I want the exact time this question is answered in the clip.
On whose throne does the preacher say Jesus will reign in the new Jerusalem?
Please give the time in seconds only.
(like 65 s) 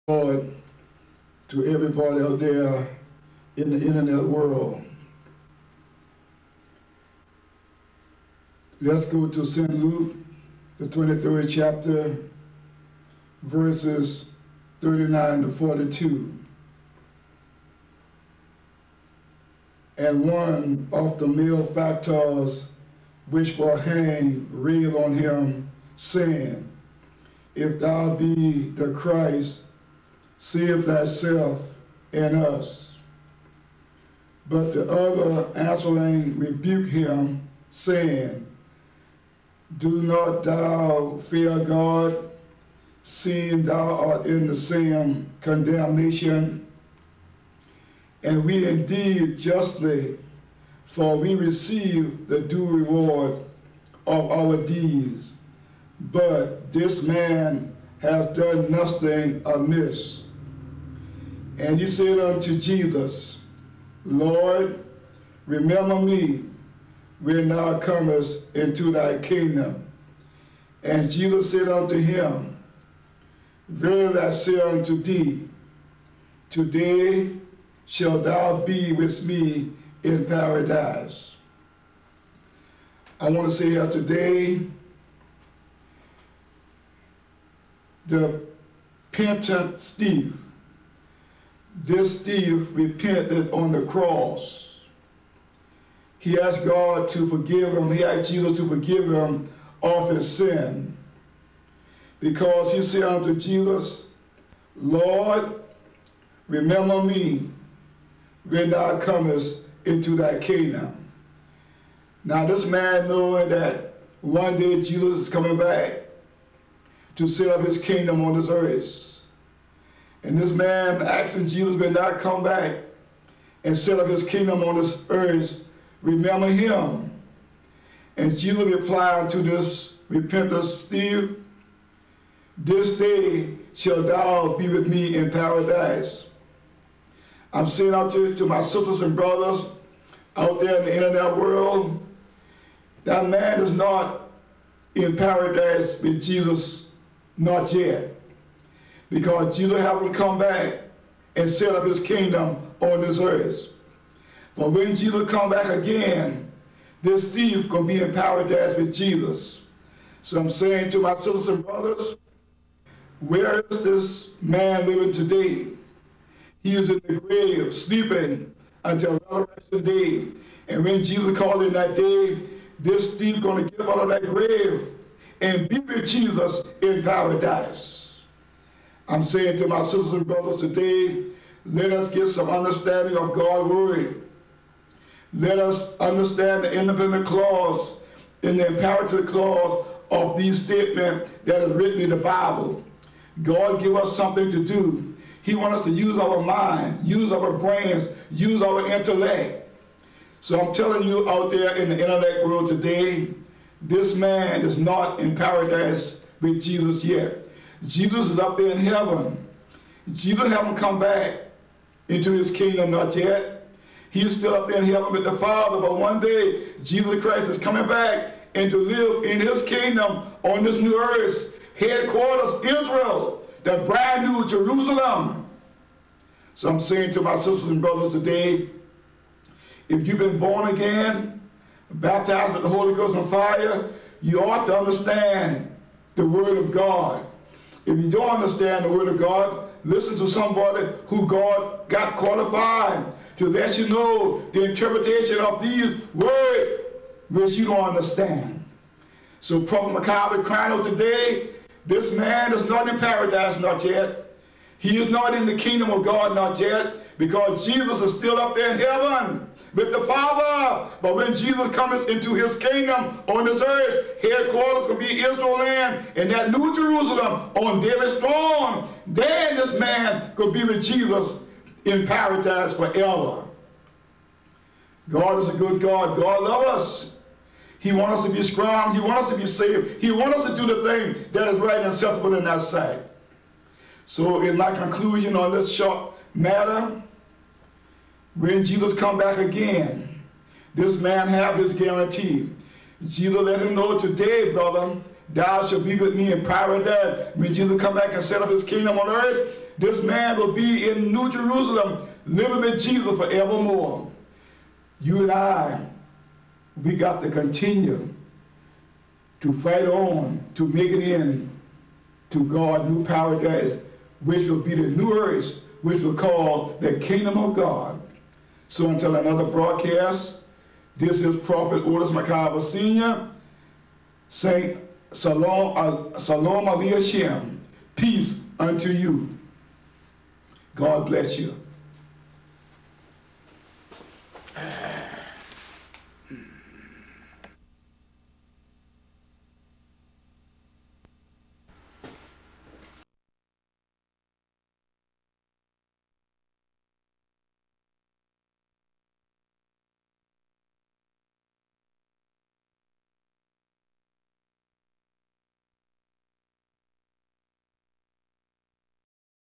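267 s.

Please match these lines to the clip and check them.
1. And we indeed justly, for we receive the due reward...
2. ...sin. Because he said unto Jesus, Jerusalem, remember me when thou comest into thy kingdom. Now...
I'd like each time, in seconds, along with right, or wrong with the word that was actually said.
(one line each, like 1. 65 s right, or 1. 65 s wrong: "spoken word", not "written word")
1. 48 s right
2. 100 s wrong: "Lord", not "Jerusalem".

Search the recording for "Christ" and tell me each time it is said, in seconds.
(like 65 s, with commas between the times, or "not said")
28 s, 217 s.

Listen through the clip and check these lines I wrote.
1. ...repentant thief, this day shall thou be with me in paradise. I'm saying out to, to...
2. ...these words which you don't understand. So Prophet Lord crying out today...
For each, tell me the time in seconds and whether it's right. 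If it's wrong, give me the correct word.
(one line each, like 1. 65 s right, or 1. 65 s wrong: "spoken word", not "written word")
1. 130 s right
2. 245 s wrong: "McIver", not "Lord".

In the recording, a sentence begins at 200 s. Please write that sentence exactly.
So I'm telling you out there in the intellect world today, this man is not in paradise with Jesus yet.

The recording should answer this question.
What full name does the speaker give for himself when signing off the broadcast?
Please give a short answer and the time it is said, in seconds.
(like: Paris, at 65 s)
Prophet Otis McIver Sr., at 321 s.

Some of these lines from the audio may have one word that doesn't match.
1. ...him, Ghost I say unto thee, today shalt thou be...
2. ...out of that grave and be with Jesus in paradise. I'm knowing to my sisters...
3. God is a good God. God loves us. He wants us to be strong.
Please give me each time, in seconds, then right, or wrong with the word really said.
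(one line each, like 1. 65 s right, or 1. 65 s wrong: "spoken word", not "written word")
1. 71 s wrong: "Verily", not "Ghost"
2. 173 s wrong: "saying", not "knowing"
3. 275 s right.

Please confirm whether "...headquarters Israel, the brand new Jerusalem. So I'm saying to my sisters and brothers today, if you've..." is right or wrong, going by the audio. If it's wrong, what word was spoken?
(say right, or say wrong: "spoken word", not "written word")
right.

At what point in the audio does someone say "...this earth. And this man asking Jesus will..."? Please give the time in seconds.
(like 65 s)
118 s.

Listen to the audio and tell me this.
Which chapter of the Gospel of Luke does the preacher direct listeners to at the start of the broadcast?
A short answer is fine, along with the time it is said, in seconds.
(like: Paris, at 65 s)
23rd, at 10 s.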